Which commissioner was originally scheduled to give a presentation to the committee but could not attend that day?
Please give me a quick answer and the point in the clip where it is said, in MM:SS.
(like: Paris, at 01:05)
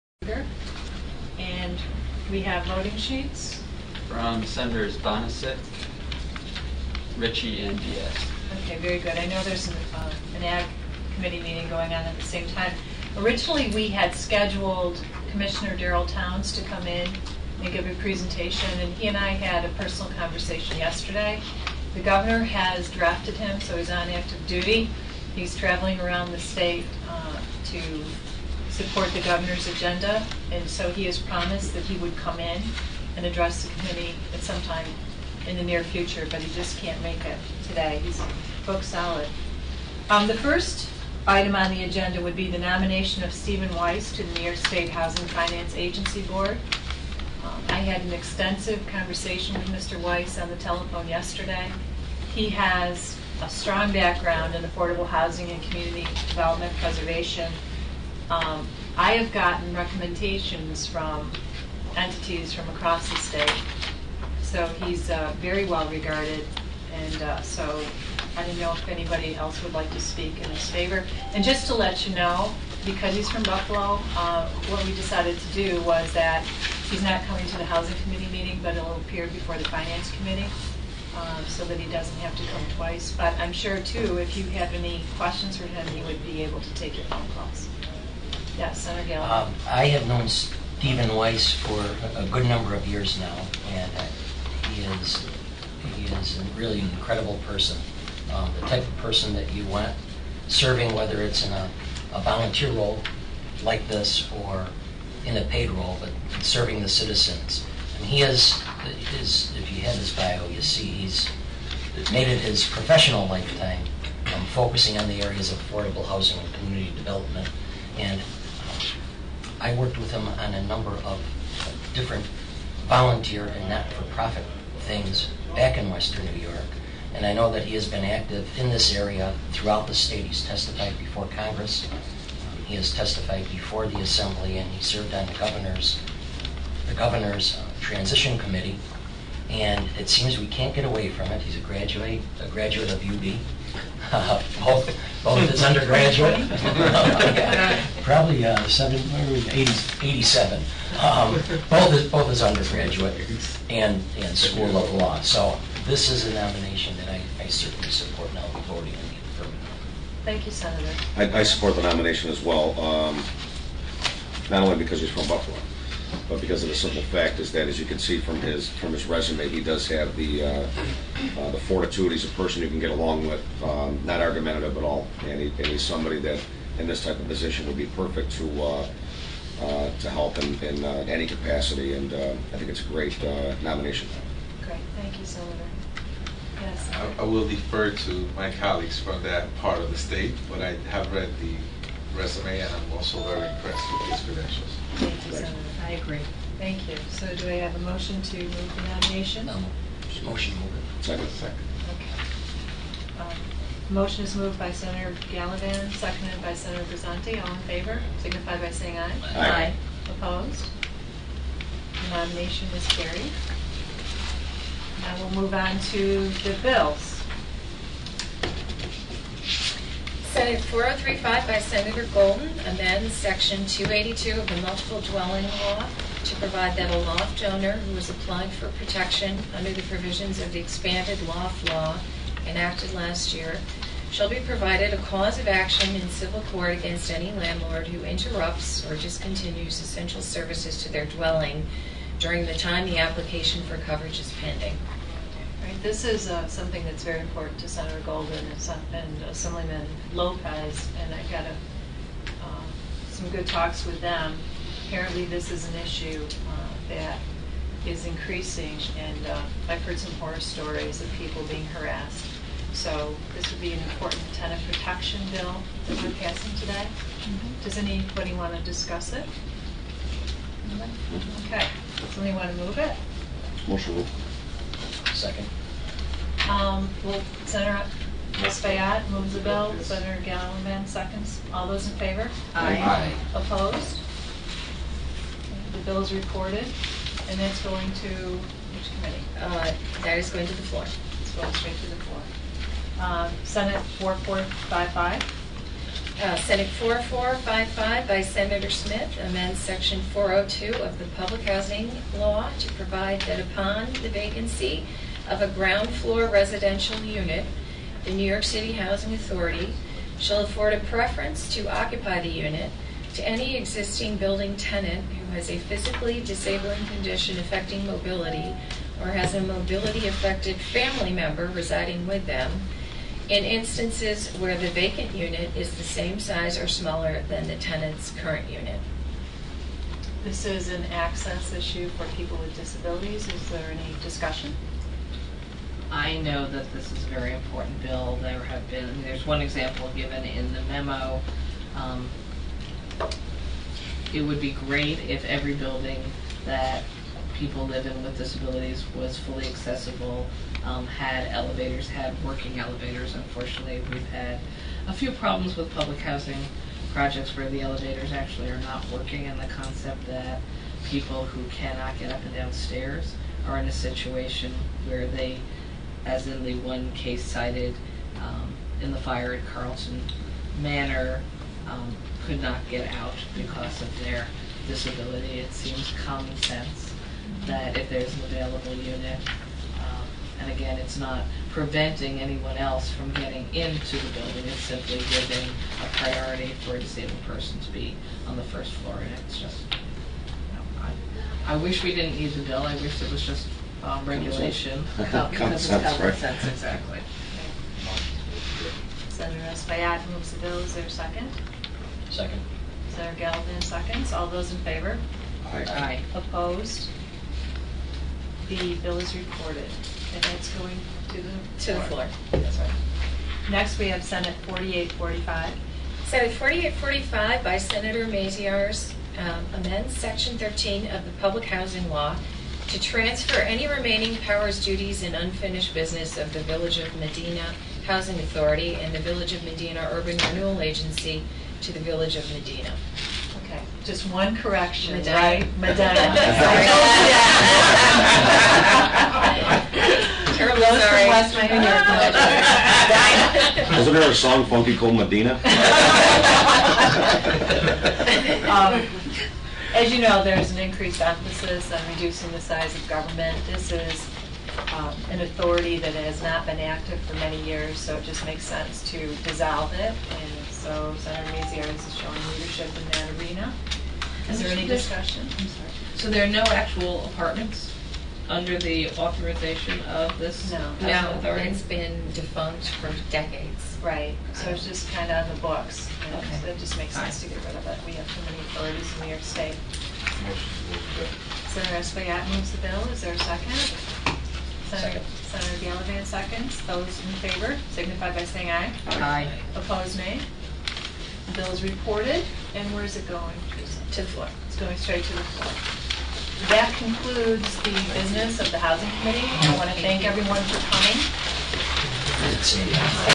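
Darryl Towns, at 00:15.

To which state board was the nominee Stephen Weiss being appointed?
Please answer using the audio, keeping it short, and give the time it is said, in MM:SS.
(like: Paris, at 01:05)
New York State Housing Finance Agency Board, at 00:44.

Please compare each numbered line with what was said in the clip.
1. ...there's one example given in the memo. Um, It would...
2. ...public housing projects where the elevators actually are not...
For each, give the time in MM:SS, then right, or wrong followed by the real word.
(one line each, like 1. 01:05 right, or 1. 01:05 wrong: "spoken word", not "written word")
1. 05:39 right
2. 05:55 right.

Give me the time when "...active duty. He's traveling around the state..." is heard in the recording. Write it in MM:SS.
00:24.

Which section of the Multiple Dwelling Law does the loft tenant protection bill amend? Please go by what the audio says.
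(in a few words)
Section 282.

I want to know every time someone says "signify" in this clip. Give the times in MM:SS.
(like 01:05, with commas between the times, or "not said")
03:28, 08:07.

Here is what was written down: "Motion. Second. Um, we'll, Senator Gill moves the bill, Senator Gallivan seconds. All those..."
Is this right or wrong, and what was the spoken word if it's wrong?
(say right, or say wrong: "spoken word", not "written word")
wrong: "Espaillat", not "Gill".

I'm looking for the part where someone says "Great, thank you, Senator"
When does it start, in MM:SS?
03:04.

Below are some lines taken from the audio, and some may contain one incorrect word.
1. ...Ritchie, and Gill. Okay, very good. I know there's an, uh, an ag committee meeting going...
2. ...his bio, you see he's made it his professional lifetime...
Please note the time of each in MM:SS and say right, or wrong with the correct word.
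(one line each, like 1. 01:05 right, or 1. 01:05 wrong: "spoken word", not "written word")
1. 00:07 wrong: "Diaz", not "Gill"
2. 01:49 right.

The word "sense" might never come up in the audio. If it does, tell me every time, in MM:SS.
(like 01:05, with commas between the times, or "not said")
06:16, 06:36, 07:38, 07:56.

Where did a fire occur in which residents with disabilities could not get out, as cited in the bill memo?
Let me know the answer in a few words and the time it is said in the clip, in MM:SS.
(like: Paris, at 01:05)
Carlton Manor, at 06:09.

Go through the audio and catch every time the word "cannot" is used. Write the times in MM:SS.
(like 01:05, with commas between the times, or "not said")
06:01.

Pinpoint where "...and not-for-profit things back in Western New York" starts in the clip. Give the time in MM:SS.
02:03.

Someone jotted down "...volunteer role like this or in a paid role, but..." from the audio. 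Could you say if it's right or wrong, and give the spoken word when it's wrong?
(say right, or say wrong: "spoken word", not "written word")
right.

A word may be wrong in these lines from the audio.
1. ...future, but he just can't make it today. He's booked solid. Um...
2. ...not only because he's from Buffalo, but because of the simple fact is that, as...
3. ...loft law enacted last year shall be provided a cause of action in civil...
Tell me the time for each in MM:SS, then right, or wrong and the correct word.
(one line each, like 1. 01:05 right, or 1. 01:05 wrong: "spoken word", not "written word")
1. 00:35 right
2. 02:44 right
3. 03:51 right.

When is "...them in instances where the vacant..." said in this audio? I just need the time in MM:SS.
05:22.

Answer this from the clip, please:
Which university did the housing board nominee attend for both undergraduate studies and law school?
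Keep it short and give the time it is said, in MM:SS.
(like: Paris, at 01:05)
UB, at 02:23.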